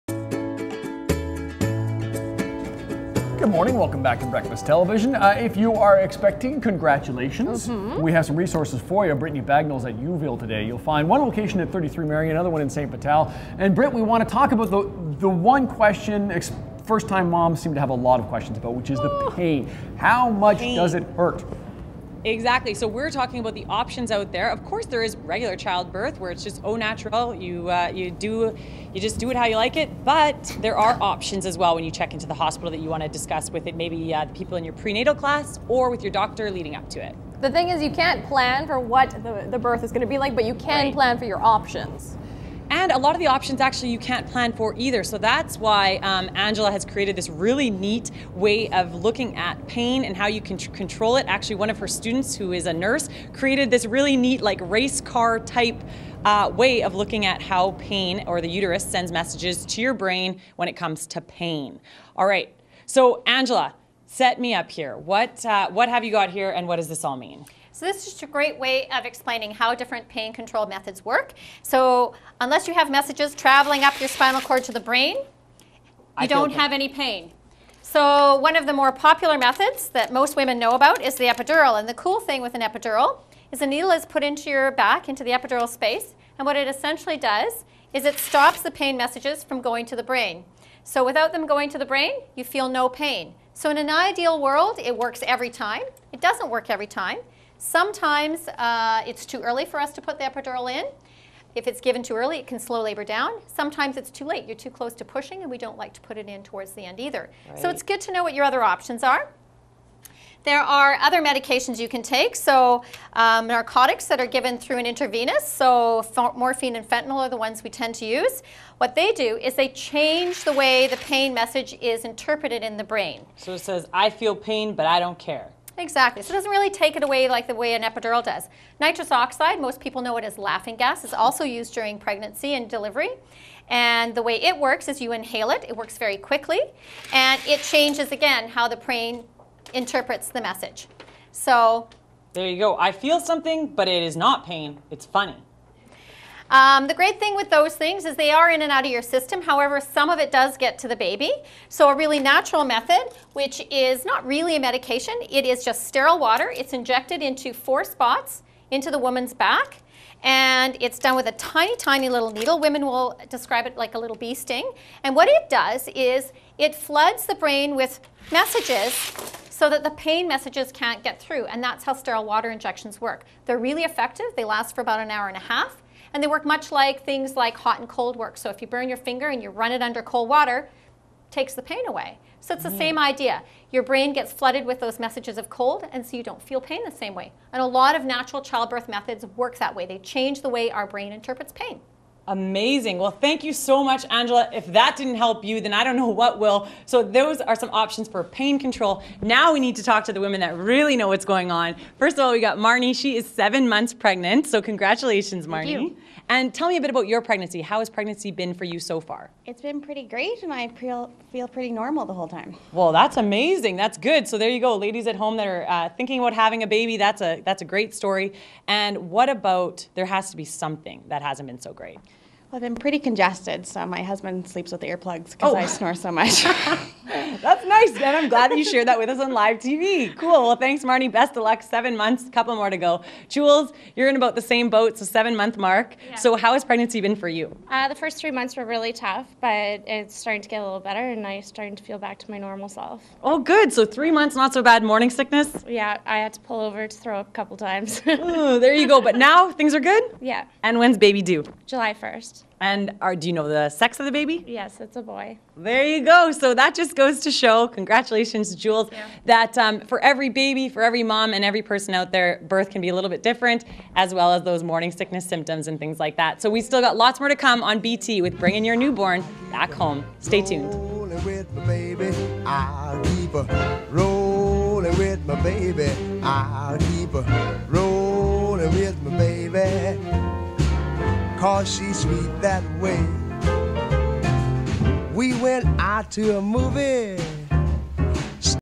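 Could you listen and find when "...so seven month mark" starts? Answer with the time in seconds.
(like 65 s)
234 s.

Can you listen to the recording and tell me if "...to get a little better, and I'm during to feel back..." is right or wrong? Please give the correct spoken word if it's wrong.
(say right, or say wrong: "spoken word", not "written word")
wrong: "starting", not "during".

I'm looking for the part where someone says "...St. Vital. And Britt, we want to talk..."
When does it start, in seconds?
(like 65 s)
12 s.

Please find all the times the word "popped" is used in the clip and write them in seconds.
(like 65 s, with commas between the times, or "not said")
not said.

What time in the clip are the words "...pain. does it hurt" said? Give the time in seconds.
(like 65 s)
20 s.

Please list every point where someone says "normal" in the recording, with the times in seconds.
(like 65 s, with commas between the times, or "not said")
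211 s, 242 s.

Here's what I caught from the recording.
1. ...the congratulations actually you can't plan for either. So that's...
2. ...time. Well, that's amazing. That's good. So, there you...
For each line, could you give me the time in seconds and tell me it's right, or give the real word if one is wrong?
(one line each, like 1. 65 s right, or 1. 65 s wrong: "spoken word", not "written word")
1. 43 s wrong: "options", not "congratulations"
2. 212 s right.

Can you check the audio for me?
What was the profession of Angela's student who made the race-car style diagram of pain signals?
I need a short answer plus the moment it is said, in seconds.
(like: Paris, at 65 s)
nurse, at 52 s.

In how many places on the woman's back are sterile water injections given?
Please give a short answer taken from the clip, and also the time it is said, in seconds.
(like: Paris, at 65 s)
4, at 157 s.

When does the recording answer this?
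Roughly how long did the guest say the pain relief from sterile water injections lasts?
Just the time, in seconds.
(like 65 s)
174 s.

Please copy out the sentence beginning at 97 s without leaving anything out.
Sometimes uh, it's too early for us to put the epidural in.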